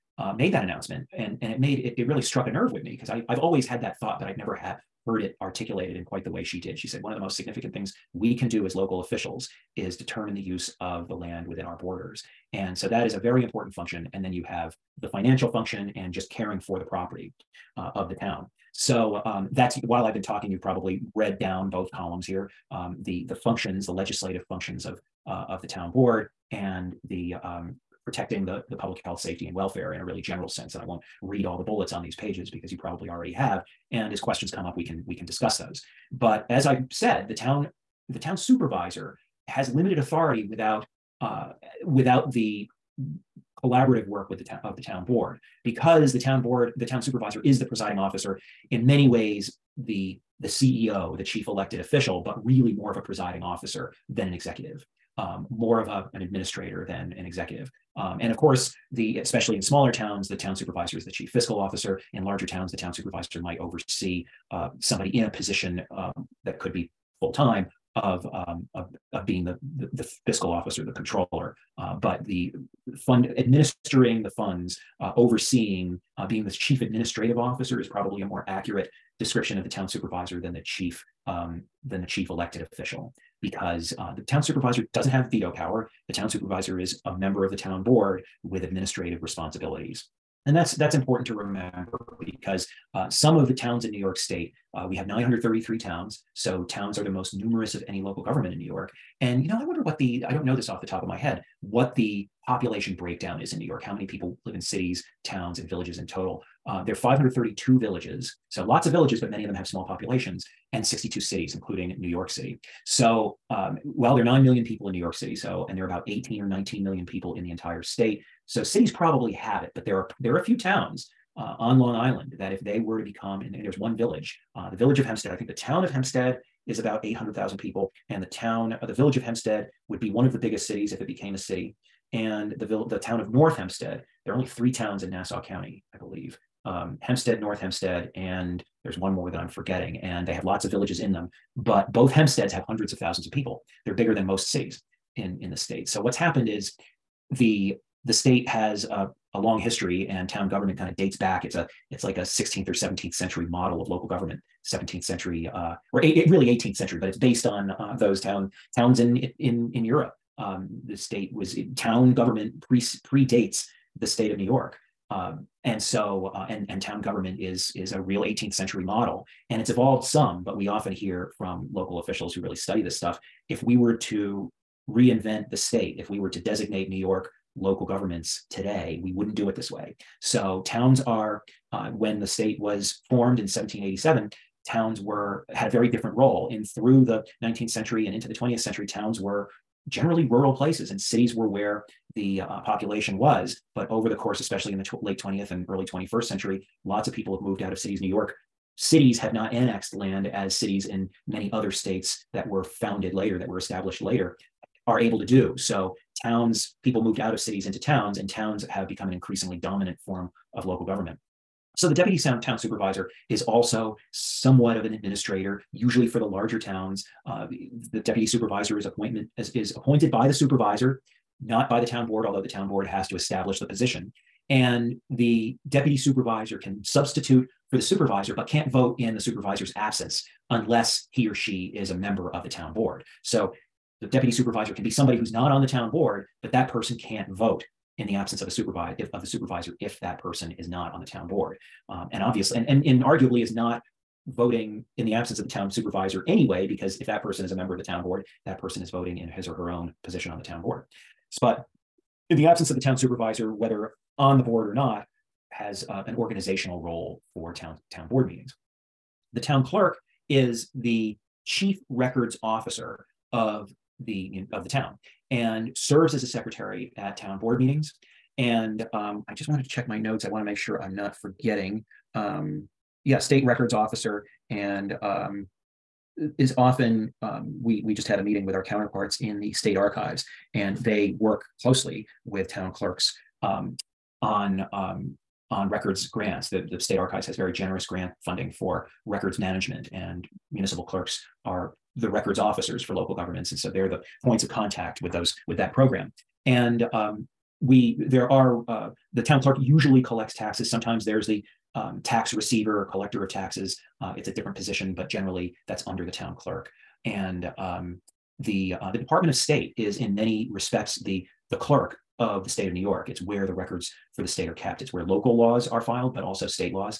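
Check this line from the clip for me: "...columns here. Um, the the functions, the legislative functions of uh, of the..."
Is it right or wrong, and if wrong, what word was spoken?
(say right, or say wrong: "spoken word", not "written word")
right.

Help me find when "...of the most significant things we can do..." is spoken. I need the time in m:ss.
0:07.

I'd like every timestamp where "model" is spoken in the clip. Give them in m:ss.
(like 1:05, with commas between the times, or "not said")
2:33, 2:48.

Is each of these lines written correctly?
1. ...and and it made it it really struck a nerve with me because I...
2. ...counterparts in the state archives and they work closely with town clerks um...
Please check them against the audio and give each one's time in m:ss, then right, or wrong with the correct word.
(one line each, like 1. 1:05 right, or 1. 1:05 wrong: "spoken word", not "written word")
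1. 0:01 right
2. 4:38 right.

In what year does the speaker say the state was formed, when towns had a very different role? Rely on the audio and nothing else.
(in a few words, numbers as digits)
1787.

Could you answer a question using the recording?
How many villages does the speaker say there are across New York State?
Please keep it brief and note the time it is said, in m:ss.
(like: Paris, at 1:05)
532, at 1:46.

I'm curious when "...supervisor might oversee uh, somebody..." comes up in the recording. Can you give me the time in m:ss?
1:02.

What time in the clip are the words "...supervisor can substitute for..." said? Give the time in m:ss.
3:45.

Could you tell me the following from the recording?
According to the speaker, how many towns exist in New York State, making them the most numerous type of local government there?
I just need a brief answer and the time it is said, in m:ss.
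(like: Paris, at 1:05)
933, at 1:35.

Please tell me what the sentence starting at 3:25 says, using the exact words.
So towns, people moved out of cities into towns, and towns have become an increasingly dominant form of local government.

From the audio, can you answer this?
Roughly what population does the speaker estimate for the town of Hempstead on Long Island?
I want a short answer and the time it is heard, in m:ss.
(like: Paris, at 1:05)
800,000, at 2:07.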